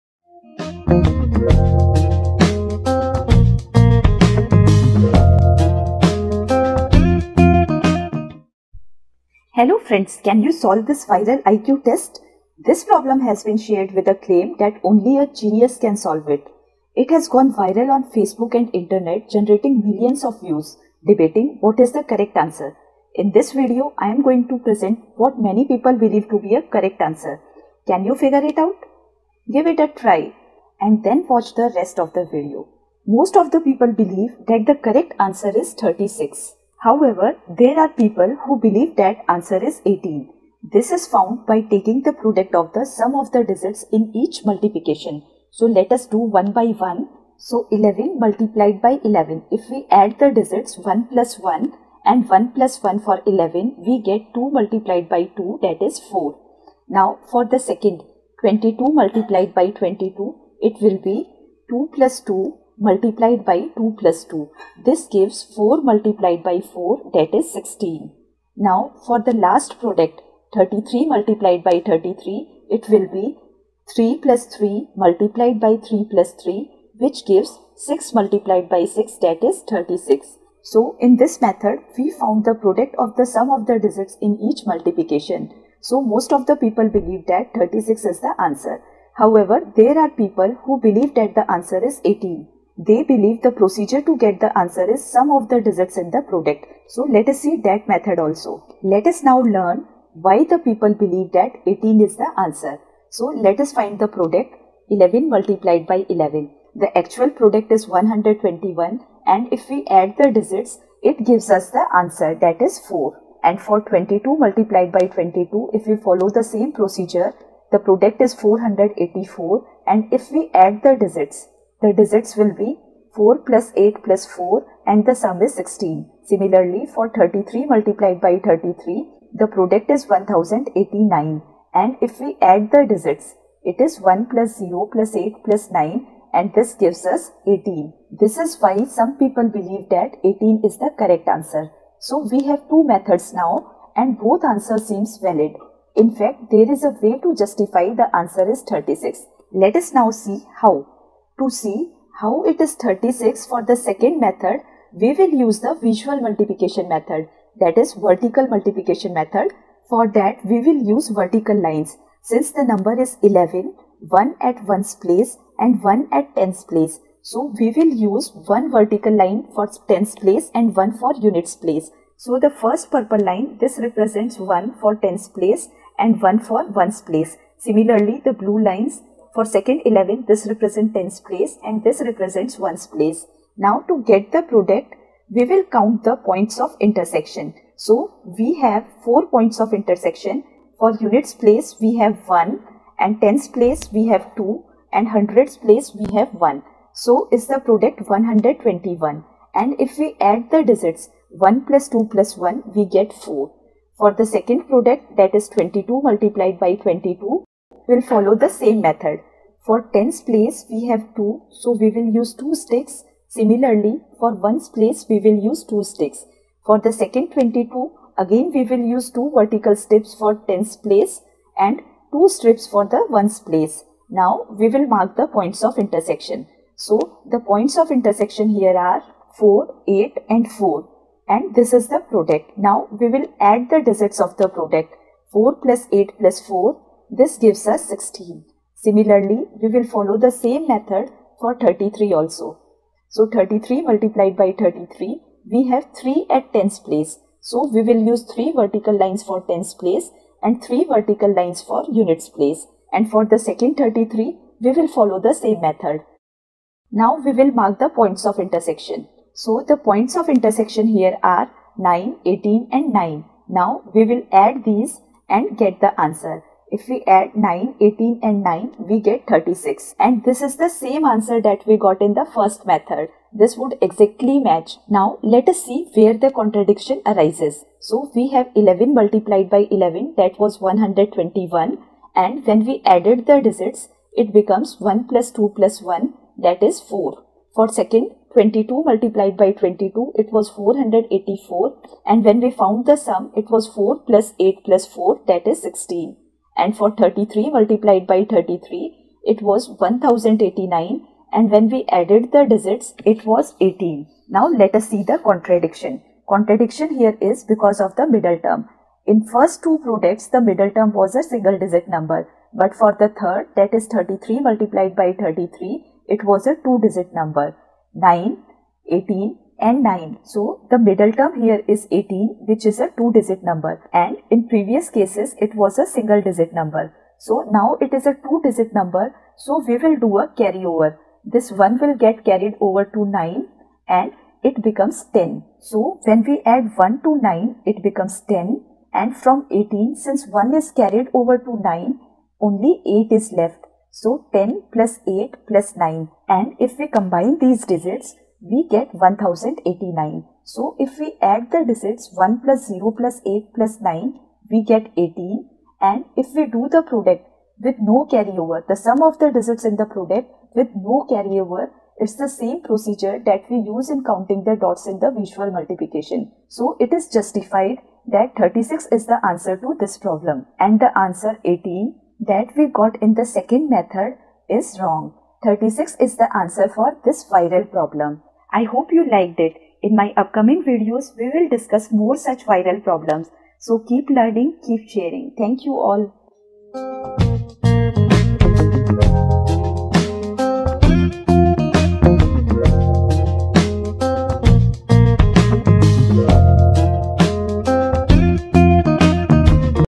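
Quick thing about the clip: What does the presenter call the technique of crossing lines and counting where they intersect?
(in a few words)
vertical multiplication method.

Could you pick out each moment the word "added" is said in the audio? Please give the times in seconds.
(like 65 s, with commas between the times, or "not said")
282 s, 301 s.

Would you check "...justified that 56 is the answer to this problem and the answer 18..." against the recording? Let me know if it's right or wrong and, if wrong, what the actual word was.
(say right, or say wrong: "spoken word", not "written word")
wrong: "36", not "56".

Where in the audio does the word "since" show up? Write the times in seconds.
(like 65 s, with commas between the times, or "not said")
162 s, 339 s.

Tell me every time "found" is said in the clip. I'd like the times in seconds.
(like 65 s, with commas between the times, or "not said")
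41 s, 82 s, 292 s.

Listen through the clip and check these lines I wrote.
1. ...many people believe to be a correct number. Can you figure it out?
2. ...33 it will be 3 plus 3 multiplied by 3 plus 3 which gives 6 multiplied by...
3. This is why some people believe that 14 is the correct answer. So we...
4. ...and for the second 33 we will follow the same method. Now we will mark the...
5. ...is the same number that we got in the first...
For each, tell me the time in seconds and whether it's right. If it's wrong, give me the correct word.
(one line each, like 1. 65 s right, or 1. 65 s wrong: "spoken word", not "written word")
1. 25 s wrong: "answer", not "number"
2. 71 s right
3. 138 s wrong: "18", not "14"
4. 252 s right
5. 270 s wrong: "answer", not "number".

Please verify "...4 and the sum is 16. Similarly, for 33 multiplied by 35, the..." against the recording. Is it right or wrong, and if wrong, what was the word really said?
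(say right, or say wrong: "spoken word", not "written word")
wrong: "33", not "35".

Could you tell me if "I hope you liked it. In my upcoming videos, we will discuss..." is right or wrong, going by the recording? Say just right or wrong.
right.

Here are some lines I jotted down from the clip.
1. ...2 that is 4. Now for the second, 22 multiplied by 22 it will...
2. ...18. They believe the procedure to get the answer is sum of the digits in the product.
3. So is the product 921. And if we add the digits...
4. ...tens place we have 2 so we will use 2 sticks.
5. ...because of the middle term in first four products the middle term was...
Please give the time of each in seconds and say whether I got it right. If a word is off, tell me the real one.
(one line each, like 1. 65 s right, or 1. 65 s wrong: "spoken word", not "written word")
1. 55 s right
2. 92 s right
3. 197 s wrong: "121", not "921"
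4. 209 s right
5. 307 s wrong: "two", not "four".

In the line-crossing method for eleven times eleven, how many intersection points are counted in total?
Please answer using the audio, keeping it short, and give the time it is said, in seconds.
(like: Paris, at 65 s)
4, at 189 s.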